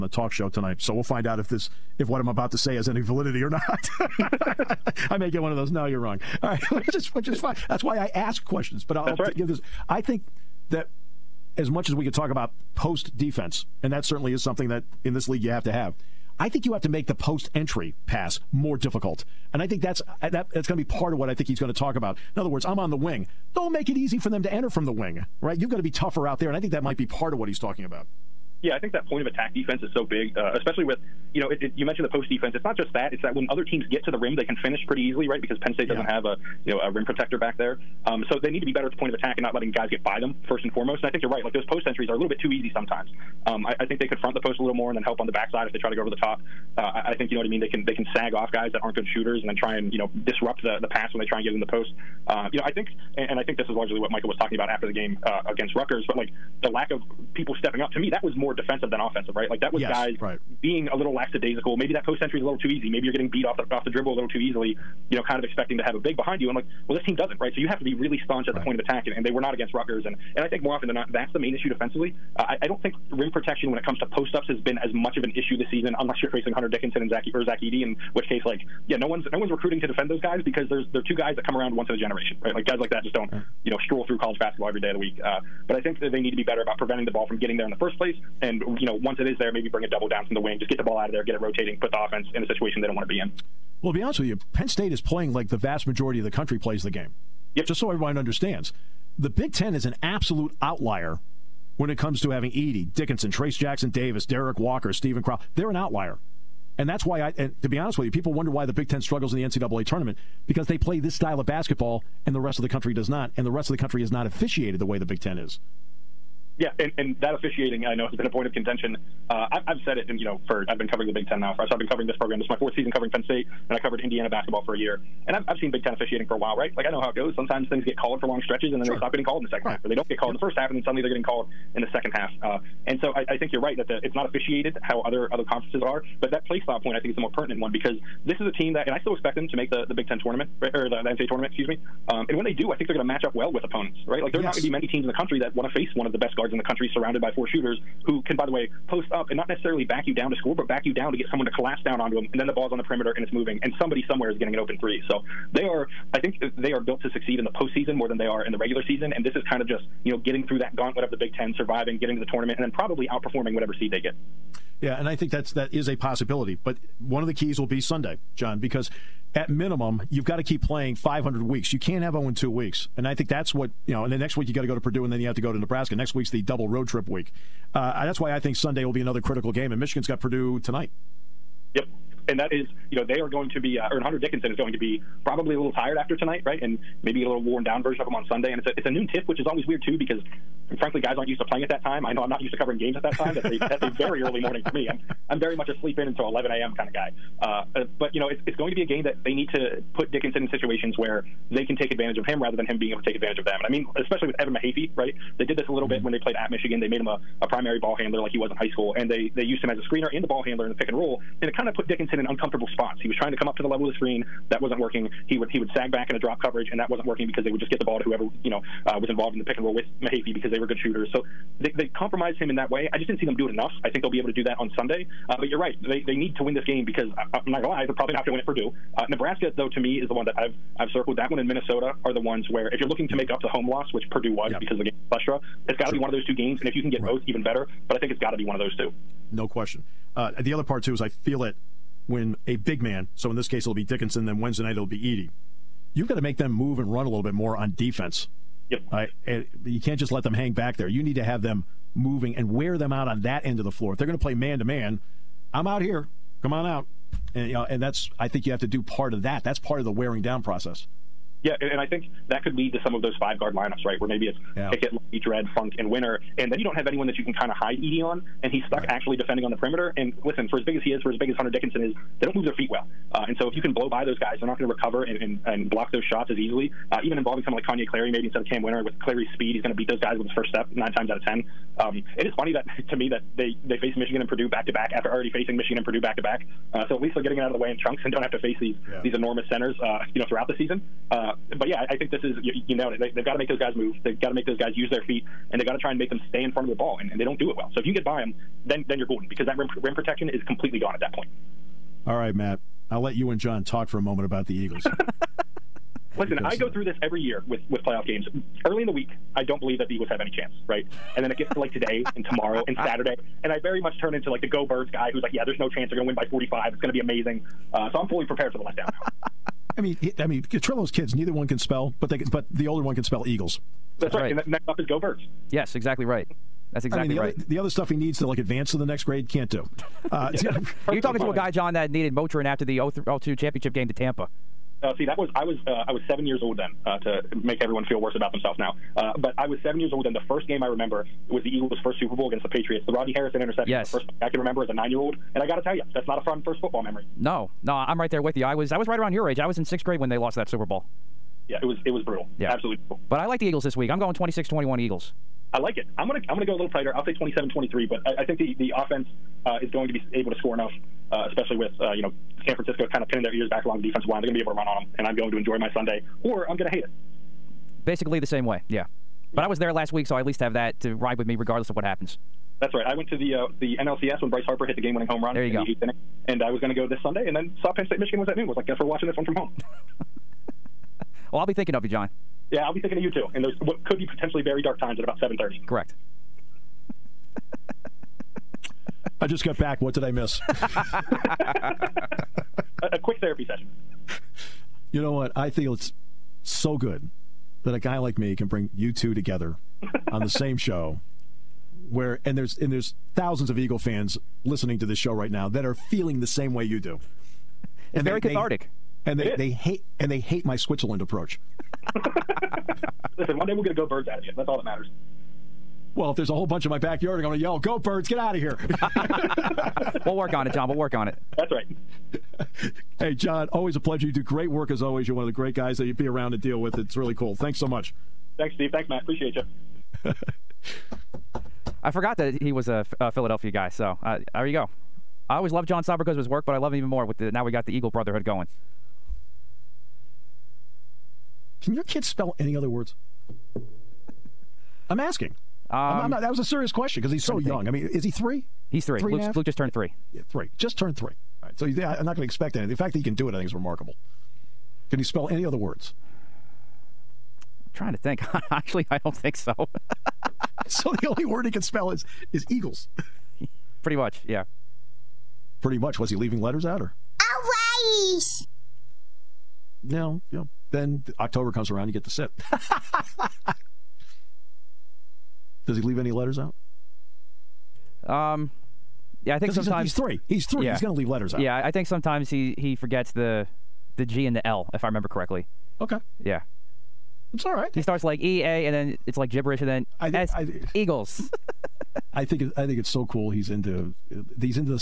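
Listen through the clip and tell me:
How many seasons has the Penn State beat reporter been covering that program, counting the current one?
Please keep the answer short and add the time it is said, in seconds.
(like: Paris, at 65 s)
4, at 122 s.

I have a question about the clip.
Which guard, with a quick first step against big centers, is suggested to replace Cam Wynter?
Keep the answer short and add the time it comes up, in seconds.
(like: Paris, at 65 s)
Kanye Clary, at 277 s.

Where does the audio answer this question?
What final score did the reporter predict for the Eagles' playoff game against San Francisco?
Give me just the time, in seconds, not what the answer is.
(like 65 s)
357 s.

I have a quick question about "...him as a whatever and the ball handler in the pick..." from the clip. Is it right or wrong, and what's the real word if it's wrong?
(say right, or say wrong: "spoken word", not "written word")
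wrong: "screener", not "whatever".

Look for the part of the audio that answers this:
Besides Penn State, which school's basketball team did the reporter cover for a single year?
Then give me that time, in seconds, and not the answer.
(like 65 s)
123 s.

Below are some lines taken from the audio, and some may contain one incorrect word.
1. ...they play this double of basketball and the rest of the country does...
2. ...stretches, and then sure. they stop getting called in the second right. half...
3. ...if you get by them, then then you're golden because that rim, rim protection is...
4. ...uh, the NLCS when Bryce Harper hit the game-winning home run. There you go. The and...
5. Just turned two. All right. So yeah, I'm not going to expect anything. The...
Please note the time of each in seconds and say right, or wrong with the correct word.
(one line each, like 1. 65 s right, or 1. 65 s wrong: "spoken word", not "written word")
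1. 110 s wrong: "style", not "double"
2. 128 s right
3. 297 s right
4. 373 s right
5. 450 s wrong: "three", not "two".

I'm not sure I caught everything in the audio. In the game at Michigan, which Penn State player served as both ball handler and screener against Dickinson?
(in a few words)
Evan Mahaffey.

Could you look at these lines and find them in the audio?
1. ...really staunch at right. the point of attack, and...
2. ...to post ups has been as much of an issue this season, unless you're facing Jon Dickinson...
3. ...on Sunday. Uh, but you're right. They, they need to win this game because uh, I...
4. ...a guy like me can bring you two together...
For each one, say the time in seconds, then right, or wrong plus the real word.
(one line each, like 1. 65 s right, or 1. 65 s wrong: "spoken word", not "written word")
1. 67 s right
2. 73 s wrong: "Hunter", not "Jon"
3. 224 s right
4. 397 s right.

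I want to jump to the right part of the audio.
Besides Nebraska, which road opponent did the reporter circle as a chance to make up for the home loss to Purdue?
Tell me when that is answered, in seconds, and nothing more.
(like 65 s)
231 s.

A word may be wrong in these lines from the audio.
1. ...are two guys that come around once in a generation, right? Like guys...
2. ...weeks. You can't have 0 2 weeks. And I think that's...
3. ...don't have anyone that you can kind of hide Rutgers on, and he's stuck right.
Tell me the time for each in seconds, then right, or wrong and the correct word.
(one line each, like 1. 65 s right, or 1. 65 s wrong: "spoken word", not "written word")
1. 81 s right
2. 171 s right
3. 266 s wrong: "Edey", not "Rutgers".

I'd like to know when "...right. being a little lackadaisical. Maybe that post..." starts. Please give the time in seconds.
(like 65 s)
60 s.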